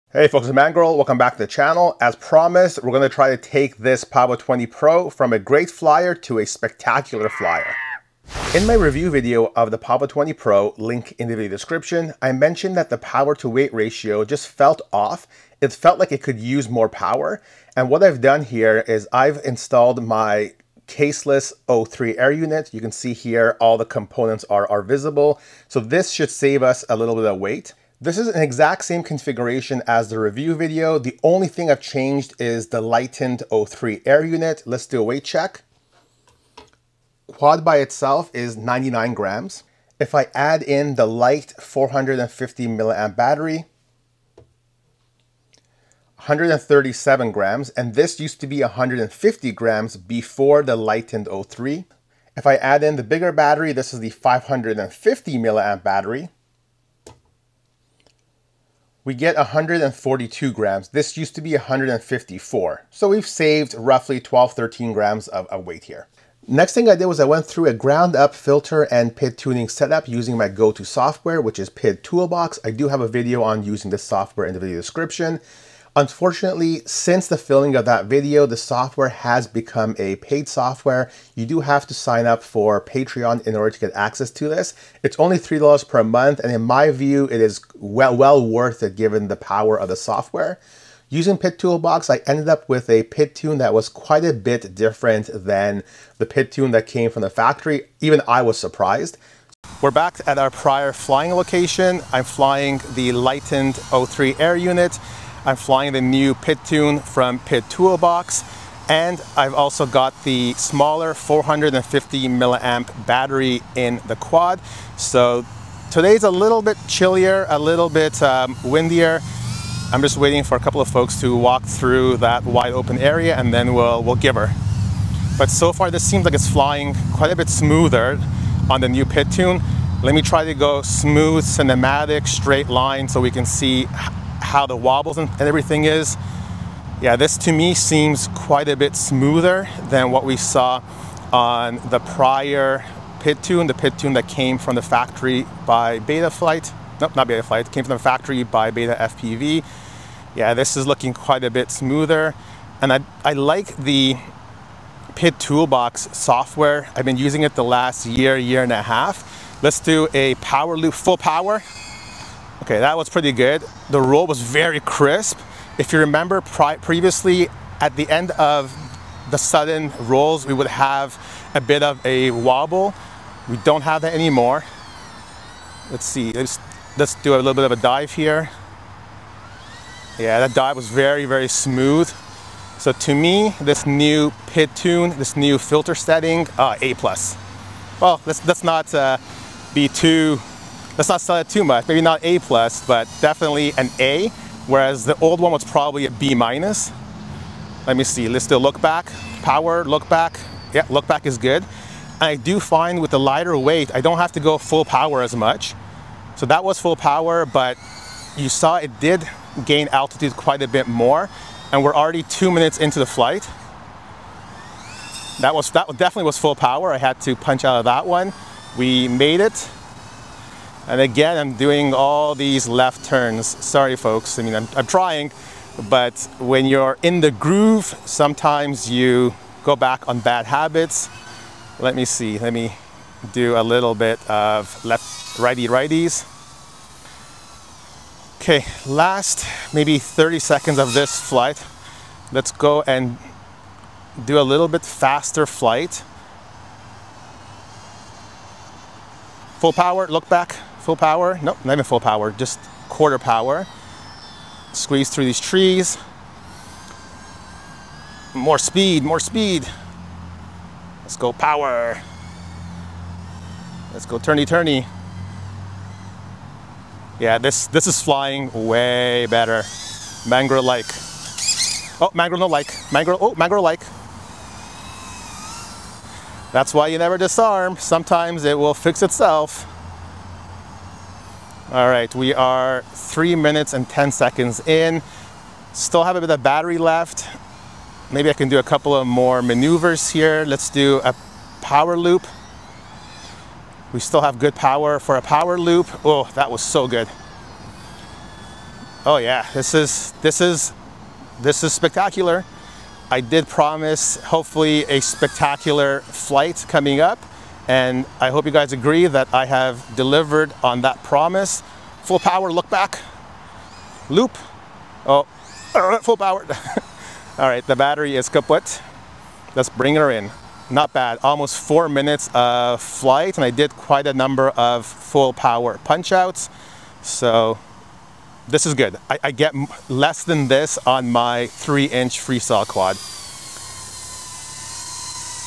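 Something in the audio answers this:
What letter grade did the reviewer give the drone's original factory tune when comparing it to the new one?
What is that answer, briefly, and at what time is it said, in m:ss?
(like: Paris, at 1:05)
B minus, at 3:16.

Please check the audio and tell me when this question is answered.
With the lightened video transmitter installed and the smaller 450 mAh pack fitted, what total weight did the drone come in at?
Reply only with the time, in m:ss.
0:46.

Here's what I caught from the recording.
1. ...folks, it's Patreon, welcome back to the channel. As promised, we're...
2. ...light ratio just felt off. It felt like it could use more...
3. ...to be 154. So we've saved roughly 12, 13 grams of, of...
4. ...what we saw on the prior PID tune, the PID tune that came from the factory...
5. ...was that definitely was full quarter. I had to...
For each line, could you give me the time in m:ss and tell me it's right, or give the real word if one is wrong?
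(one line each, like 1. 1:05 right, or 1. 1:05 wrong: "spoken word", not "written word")
1. 0:00 wrong: "Mangorille", not "Patreon"
2. 0:13 wrong: "weight", not "light"
3. 1:01 right
4. 2:20 right
5. 3:35 wrong: "power", not "quarter".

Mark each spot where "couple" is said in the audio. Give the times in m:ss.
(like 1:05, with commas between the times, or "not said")
2:00, 4:48.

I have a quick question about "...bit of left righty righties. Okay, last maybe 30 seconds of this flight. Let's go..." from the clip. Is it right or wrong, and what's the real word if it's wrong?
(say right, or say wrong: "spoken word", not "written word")
right.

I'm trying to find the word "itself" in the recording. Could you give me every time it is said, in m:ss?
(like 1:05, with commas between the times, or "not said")
0:37, 4:39.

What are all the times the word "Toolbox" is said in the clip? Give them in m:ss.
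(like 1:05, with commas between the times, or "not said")
1:12, 1:31, 1:47, 2:35.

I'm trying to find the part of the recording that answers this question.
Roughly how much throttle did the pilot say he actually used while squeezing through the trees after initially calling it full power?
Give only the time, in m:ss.
4:12.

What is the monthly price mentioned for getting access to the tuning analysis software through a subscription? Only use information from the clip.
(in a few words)
$3.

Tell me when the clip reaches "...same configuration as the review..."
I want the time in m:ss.
0:28.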